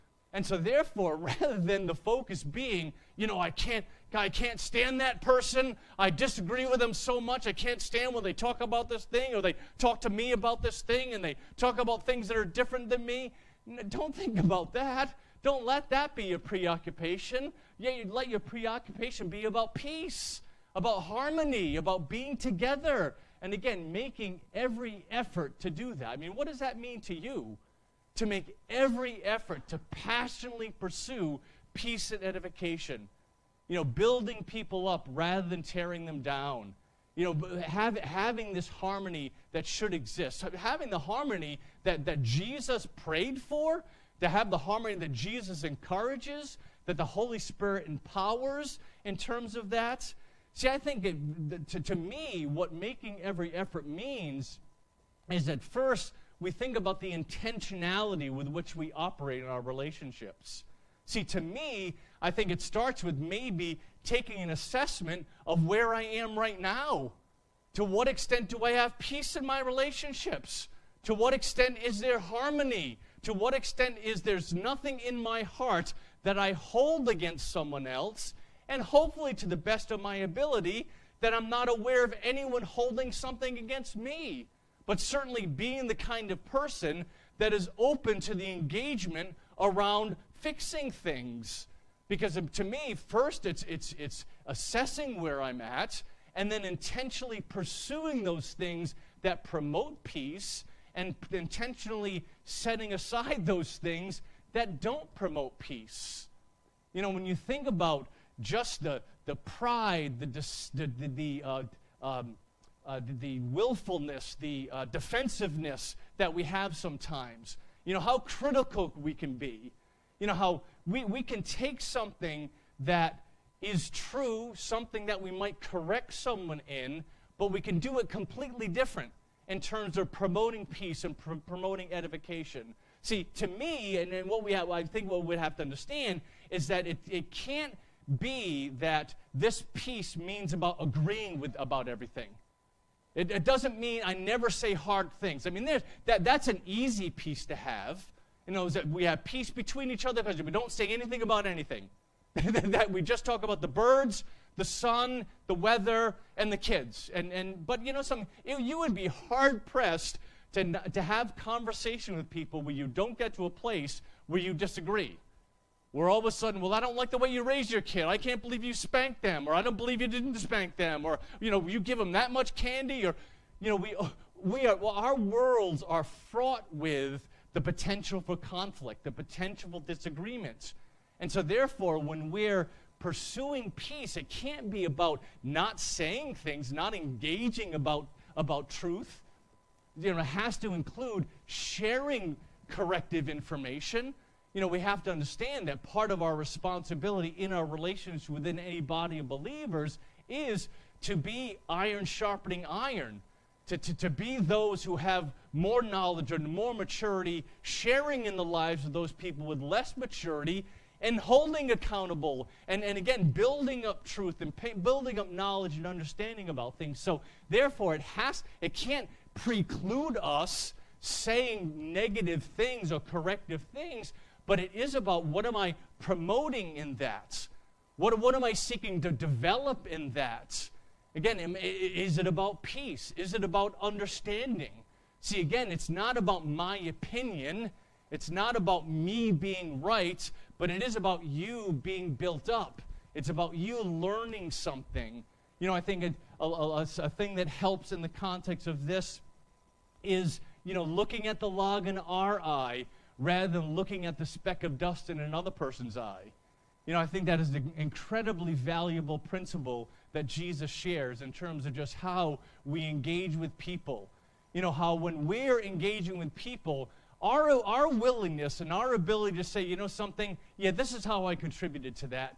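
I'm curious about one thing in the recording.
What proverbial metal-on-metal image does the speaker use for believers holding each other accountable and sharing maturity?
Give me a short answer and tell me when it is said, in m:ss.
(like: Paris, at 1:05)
Iron sharpening iron, at 3:21.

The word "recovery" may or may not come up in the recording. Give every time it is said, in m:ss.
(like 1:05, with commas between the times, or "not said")
not said.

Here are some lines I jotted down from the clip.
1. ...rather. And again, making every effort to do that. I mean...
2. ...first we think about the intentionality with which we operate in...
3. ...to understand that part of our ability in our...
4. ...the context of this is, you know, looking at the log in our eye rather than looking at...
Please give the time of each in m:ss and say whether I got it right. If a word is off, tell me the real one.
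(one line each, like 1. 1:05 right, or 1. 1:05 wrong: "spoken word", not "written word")
1. 0:22 wrong: "together", not "rather"
2. 0:55 right
3. 3:15 wrong: "responsibility", not "ability"
4. 4:08 right.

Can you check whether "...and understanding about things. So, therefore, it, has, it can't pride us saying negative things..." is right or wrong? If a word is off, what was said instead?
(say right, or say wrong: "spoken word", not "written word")
wrong: "preclude", not "pride".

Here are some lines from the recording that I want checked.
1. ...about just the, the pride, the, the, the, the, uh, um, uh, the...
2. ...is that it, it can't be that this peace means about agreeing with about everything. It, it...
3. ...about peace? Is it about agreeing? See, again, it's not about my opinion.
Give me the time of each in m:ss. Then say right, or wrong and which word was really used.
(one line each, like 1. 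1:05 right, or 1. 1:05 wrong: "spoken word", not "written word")
1. 1:47 right
2. 2:16 right
3. 3:52 wrong: "understanding", not "agreeing".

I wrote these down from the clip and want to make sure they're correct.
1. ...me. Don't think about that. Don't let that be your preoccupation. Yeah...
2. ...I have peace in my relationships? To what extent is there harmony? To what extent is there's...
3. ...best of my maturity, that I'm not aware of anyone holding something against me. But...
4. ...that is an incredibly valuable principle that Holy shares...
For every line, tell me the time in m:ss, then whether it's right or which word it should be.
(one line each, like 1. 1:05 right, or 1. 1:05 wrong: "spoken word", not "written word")
1. 0:13 right
2. 1:08 right
3. 1:19 wrong: "ability", not "maturity"
4. 4:17 wrong: "Jesus", not "Holy".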